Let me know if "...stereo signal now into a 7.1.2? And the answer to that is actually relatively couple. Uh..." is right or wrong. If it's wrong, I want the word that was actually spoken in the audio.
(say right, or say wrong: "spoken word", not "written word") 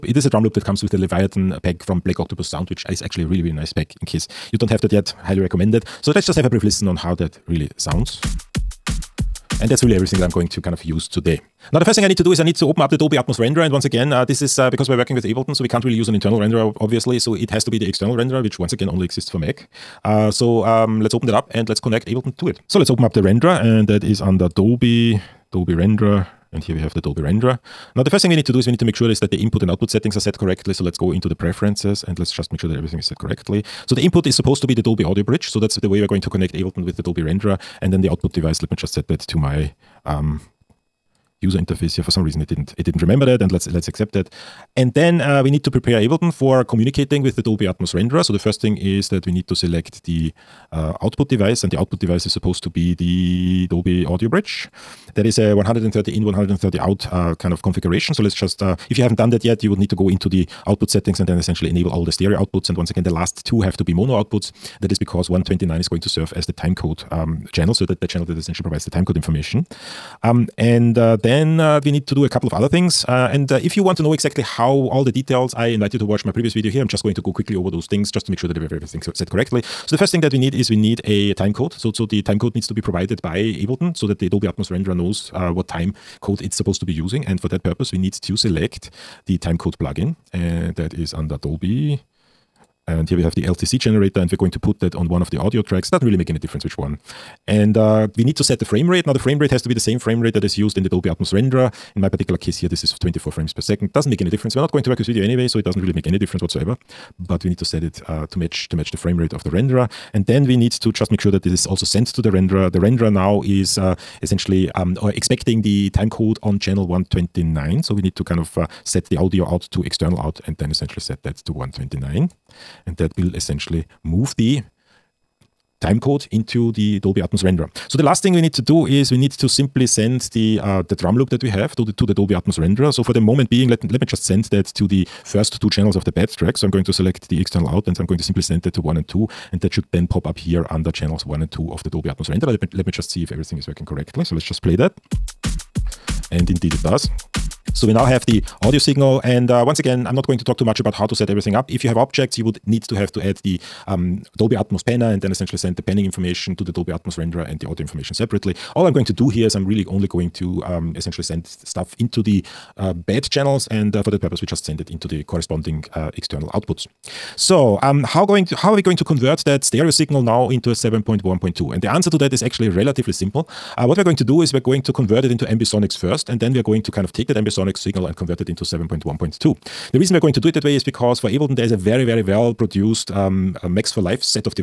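wrong: "simple", not "couple".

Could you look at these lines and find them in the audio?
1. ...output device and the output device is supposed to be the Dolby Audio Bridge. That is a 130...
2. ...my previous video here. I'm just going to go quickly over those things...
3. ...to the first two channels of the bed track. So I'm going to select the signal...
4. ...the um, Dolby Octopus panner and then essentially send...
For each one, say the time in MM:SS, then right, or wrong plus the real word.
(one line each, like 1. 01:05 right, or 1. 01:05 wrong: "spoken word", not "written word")
1. 00:51 right
2. 01:16 right
3. 02:14 wrong: "external", not "signal"
4. 02:33 wrong: "Atmos", not "Octopus".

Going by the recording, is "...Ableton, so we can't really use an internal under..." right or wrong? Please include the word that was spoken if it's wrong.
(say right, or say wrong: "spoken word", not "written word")
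wrong: "renderer", not "under".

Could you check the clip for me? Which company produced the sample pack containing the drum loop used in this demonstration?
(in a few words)
Black Octopus Sound.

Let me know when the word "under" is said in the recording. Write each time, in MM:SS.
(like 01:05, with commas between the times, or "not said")
00:24, 01:31, 02:20.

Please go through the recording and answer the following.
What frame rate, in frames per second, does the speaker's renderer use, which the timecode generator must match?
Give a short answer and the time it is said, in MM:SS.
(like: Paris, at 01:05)
24, at 01:42.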